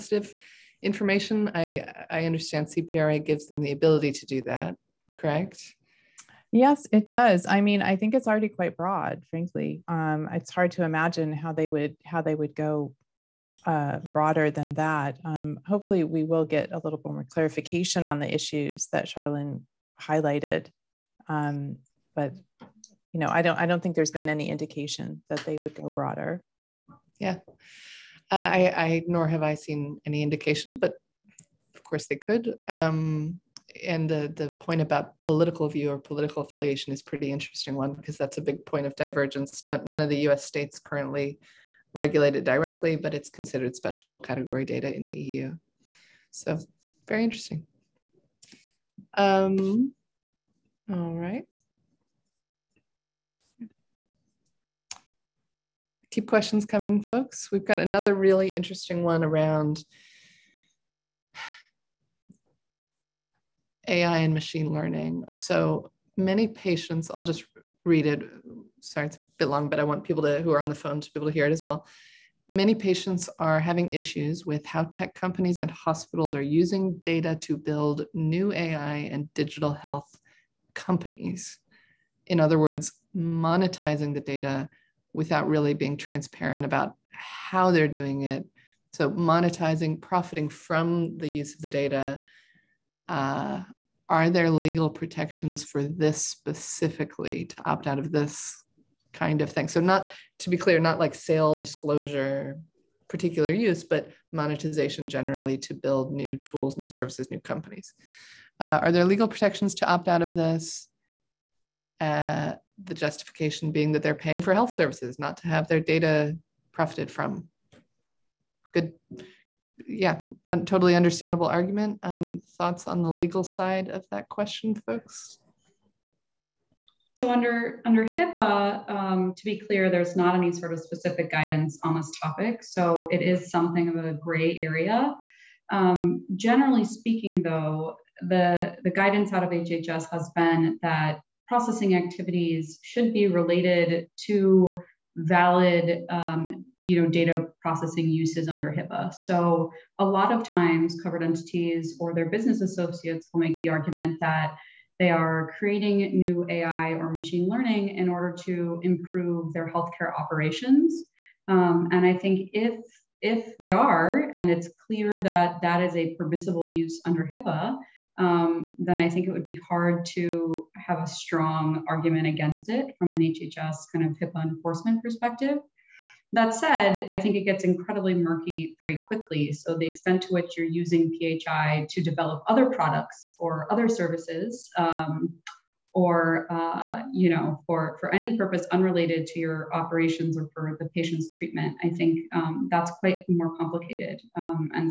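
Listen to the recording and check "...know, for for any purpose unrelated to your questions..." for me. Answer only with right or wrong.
wrong.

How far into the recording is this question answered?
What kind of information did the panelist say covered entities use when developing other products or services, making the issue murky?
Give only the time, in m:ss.
3:01.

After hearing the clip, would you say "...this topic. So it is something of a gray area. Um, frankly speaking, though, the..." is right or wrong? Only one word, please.
wrong.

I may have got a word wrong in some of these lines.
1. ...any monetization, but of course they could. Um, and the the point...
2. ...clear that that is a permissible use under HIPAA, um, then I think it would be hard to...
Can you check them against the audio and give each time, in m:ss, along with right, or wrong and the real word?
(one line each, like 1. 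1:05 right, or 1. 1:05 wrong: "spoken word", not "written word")
1. 0:30 wrong: "indication", not "monetization"
2. 2:44 right.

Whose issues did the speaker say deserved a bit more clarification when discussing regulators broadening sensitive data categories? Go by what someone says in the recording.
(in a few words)
Charlyn.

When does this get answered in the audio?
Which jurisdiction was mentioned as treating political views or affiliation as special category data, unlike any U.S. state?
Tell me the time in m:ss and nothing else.
0:45.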